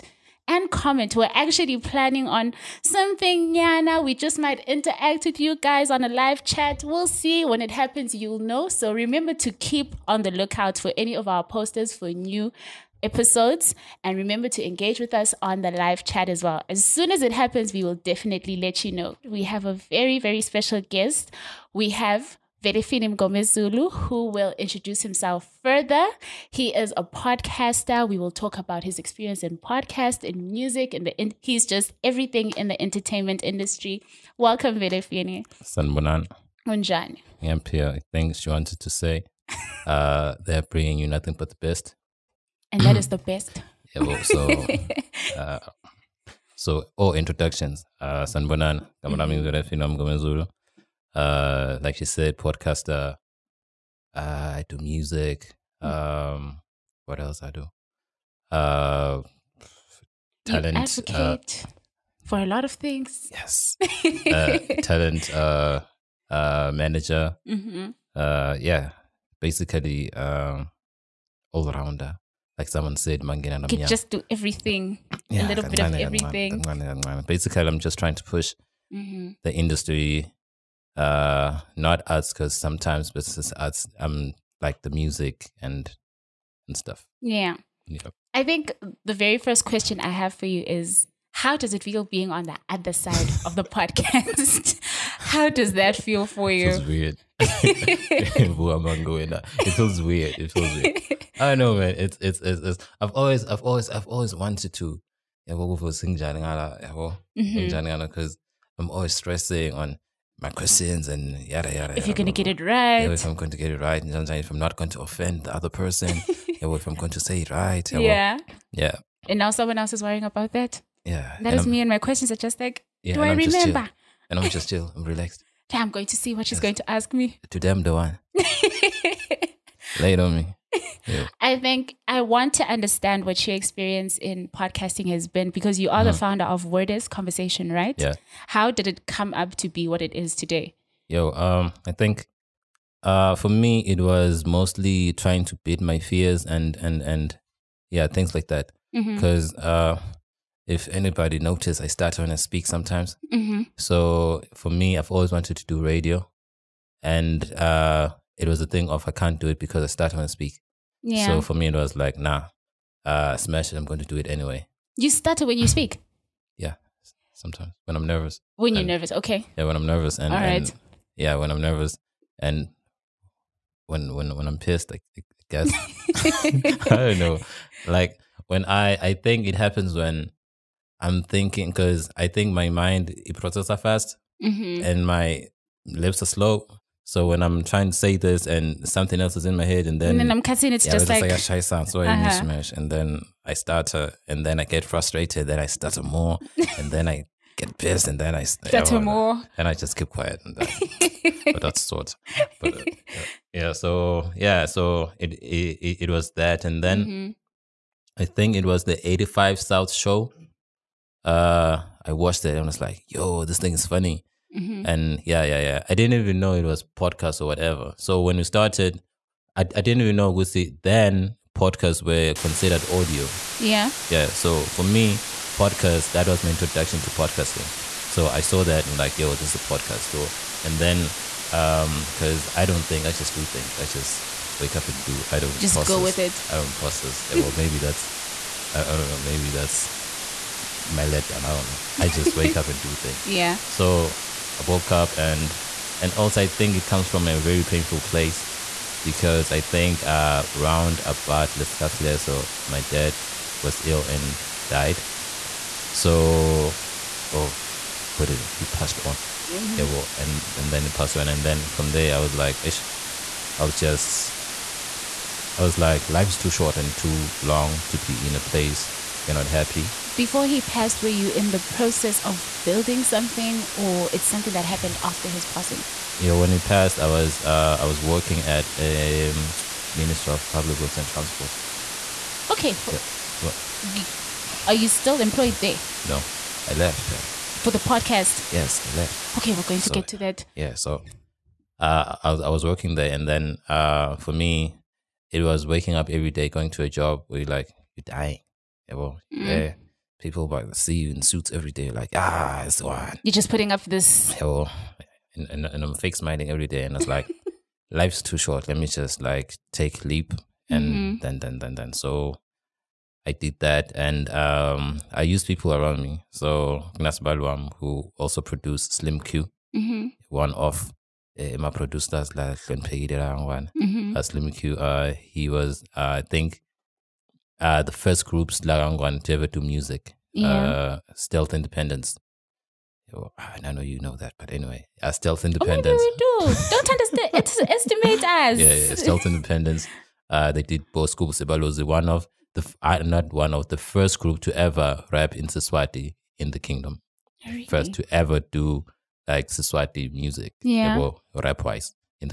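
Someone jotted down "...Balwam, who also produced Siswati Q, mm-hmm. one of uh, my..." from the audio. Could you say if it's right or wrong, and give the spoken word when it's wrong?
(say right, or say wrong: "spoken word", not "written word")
wrong: "Slim", not "Siswati".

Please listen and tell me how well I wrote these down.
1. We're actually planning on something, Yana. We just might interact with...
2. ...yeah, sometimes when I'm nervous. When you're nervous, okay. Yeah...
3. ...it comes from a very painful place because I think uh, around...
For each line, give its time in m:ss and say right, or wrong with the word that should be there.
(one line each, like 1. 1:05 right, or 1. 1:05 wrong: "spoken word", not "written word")
1. 0:01 right
2. 2:46 right
3. 4:06 right.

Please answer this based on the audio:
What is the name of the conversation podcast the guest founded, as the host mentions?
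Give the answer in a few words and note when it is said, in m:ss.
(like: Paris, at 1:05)
WORD!S Conversation, at 2:16.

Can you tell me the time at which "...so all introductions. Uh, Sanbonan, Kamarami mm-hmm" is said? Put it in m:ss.
0:46.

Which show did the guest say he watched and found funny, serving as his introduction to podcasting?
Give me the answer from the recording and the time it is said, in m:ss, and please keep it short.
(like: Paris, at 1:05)
'85 South show, at 3:29.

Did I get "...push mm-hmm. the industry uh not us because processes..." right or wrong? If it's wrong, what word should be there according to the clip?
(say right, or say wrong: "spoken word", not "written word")
wrong: "sometimes", not "processes".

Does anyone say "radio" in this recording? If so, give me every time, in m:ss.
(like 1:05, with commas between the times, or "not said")
2:35.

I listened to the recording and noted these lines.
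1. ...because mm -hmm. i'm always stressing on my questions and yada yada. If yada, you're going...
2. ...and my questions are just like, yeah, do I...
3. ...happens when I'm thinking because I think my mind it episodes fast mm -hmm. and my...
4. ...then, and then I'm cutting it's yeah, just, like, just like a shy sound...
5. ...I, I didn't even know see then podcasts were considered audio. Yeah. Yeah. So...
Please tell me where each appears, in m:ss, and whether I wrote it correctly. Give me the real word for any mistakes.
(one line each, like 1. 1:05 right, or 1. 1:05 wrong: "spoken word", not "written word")
1. 1:45 right
2. 2:01 right
3. 2:59 wrong: "processes", not "episodes"
4. 3:10 right
5. 3:39 right.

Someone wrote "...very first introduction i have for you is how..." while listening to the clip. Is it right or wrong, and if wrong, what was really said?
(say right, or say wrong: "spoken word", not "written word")
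wrong: "question", not "introduction".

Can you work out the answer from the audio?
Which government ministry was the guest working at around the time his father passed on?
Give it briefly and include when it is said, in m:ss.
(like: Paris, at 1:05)
Ministry of Public Works and Transport, at 4:39.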